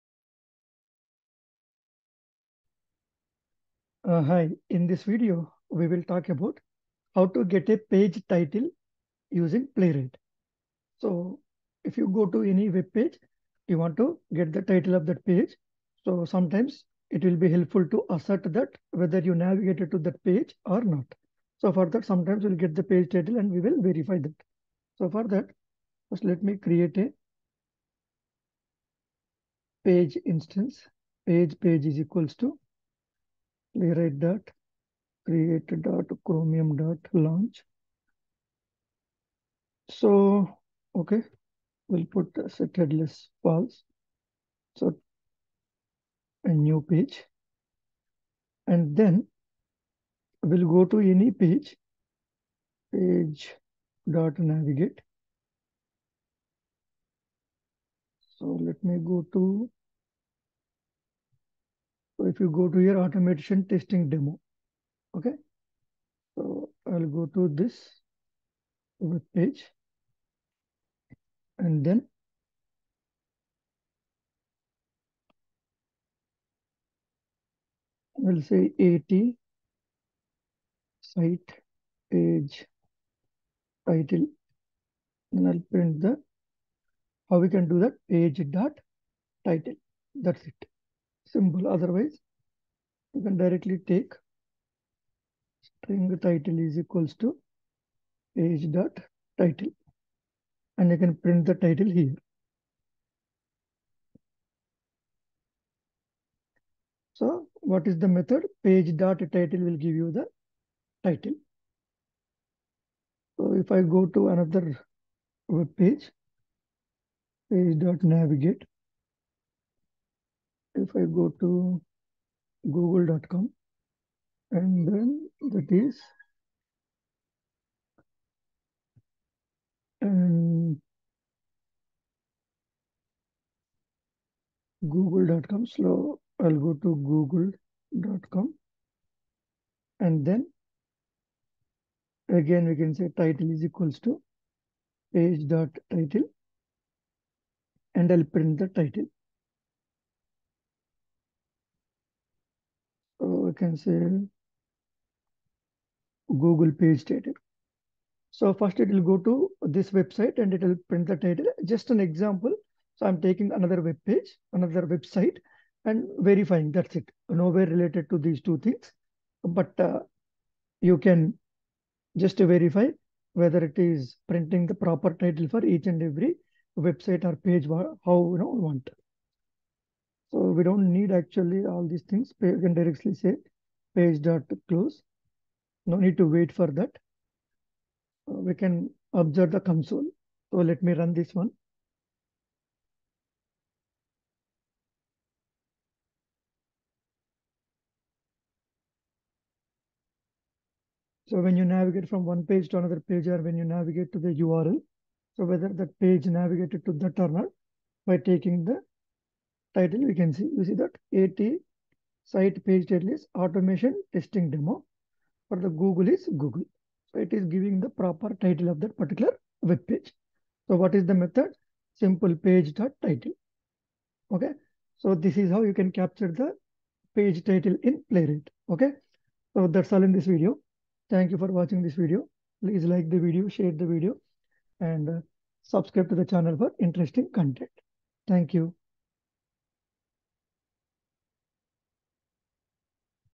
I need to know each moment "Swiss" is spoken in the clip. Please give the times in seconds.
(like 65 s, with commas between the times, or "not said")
not said.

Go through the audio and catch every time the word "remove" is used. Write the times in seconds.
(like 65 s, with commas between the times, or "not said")
not said.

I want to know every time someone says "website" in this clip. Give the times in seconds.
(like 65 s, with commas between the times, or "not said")
159 s, 164 s, 176 s.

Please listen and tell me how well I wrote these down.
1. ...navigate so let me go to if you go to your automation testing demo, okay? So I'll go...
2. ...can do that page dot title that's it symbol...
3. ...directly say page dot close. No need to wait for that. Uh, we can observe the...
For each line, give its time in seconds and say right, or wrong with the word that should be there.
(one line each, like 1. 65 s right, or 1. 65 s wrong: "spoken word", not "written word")
1. 54 s right
2. 87 s right
3. 182 s right.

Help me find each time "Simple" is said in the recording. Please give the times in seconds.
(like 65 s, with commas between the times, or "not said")
221 s.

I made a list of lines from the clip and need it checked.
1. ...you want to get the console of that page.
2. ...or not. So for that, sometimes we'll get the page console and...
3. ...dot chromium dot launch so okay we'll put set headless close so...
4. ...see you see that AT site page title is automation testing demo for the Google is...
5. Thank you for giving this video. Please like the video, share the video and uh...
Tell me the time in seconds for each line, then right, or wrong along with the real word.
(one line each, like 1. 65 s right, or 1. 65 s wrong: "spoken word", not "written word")
1. 13 s wrong: "title", not "console"
2. 20 s wrong: "title", not "console"
3. 35 s wrong: "false", not "close"
4. 210 s right
5. 231 s wrong: "watching", not "giving".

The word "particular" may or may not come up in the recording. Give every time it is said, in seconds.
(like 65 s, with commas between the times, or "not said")
218 s.